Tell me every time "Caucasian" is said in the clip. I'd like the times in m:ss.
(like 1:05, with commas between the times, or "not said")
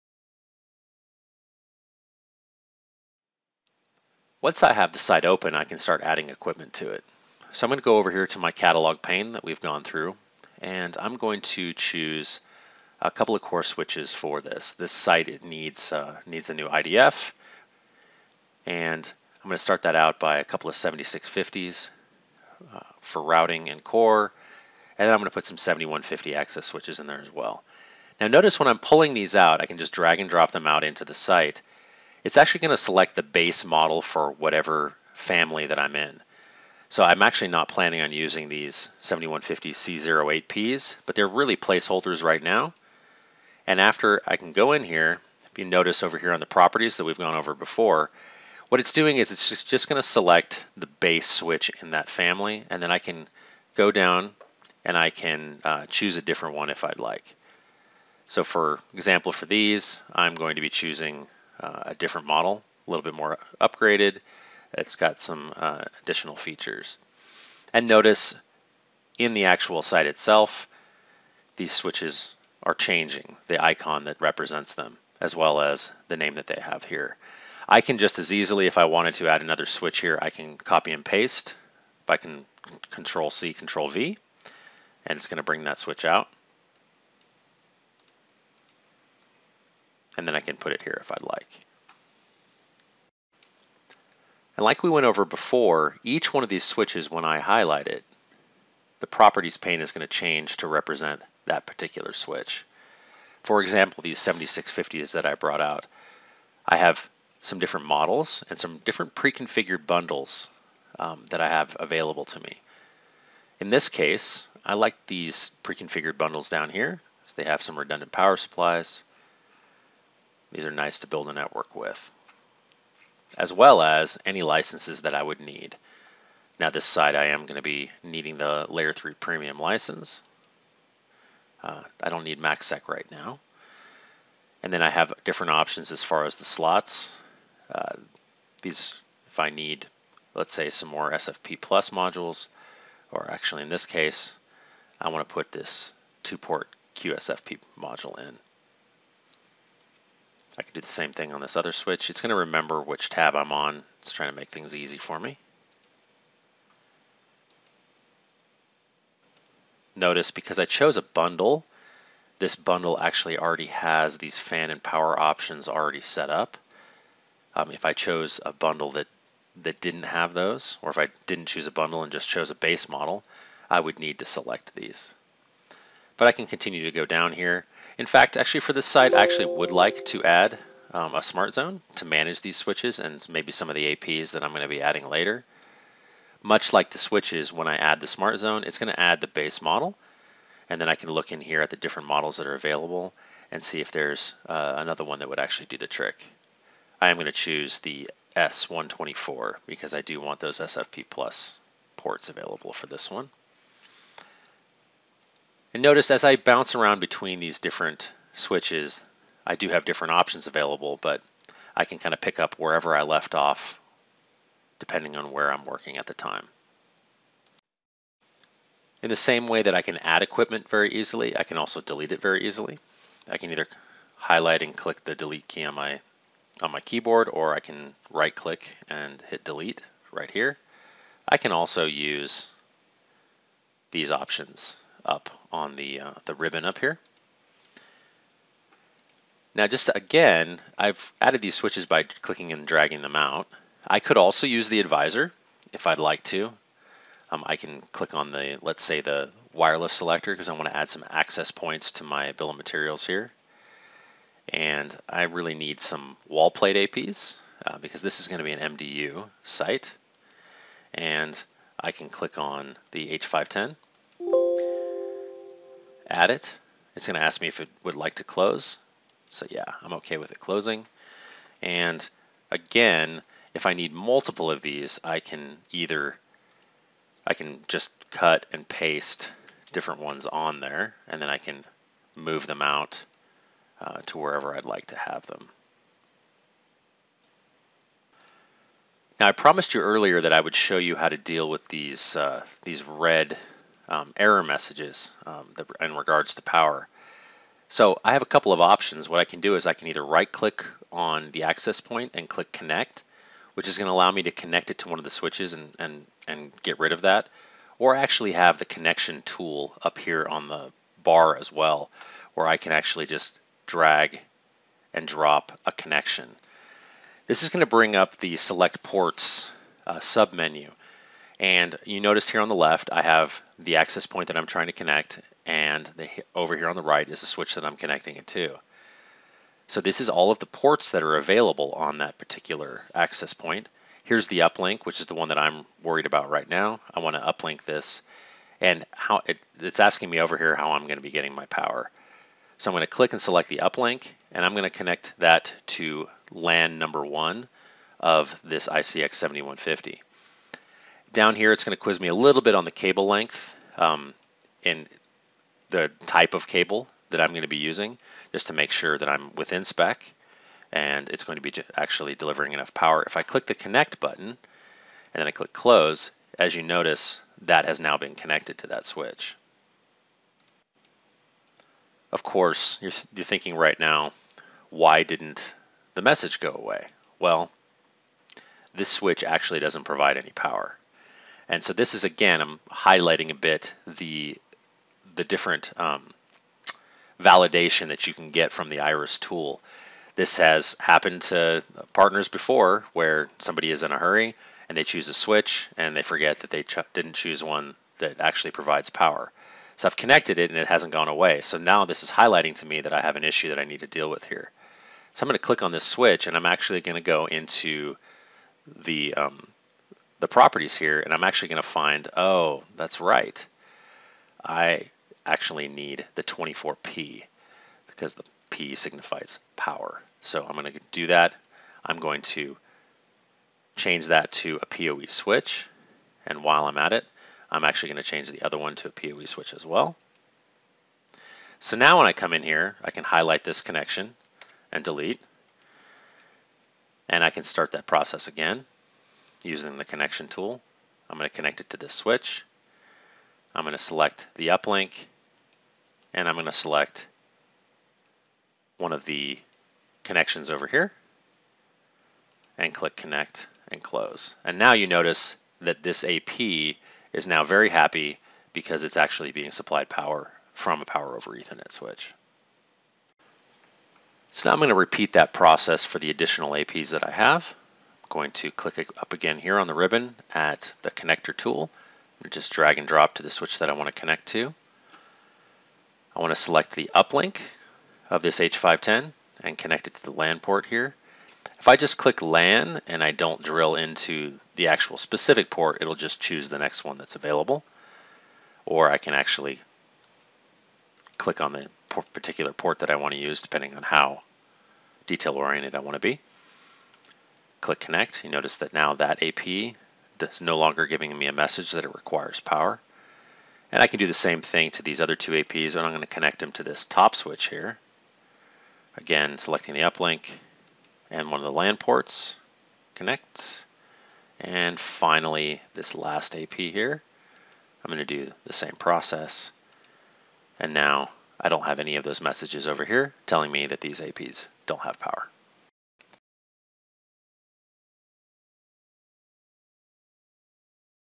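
not said.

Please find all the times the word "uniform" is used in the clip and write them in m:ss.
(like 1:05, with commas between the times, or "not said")
not said.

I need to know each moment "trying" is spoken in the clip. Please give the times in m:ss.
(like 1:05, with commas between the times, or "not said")
2:34, 5:24.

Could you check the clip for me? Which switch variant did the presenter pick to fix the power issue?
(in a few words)
24P.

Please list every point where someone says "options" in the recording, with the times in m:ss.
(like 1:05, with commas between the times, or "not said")
2:15, 2:45, 3:30, 3:54, 4:58.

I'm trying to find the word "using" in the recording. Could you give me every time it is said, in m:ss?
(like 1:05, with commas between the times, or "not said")
0:38, 5:57, 7:19.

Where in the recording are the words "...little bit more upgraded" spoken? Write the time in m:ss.
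1:02.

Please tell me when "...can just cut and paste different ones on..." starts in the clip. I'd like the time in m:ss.
4:37.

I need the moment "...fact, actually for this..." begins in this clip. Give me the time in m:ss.
2:58.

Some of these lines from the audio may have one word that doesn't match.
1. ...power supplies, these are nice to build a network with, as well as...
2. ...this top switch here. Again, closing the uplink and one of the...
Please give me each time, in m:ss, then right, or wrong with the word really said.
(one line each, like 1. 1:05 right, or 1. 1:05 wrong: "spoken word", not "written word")
1. 1:58 right
2. 8:26 wrong: "selecting", not "closing".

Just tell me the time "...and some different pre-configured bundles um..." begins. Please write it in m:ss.
1:48.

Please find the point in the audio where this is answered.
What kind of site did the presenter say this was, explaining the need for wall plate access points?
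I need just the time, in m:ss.
4:18.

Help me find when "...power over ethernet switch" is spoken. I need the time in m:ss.
7:40.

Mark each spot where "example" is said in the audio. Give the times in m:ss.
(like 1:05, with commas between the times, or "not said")
0:58, 1:43.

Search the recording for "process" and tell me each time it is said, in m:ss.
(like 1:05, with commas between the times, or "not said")
7:17, 7:45, 8:38.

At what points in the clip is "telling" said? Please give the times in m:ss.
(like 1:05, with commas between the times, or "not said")
8:43.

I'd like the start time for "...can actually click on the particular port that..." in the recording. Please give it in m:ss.
8:08.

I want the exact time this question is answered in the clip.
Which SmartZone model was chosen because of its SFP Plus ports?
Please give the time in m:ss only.
3:18.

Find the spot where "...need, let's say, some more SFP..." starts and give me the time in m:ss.
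2:19.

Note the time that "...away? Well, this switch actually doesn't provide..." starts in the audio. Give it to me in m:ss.
6:16.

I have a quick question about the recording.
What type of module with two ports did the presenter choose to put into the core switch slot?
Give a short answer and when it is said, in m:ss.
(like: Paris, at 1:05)
QSFP, at 2:26.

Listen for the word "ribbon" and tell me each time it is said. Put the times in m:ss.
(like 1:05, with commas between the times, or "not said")
3:56, 7:49.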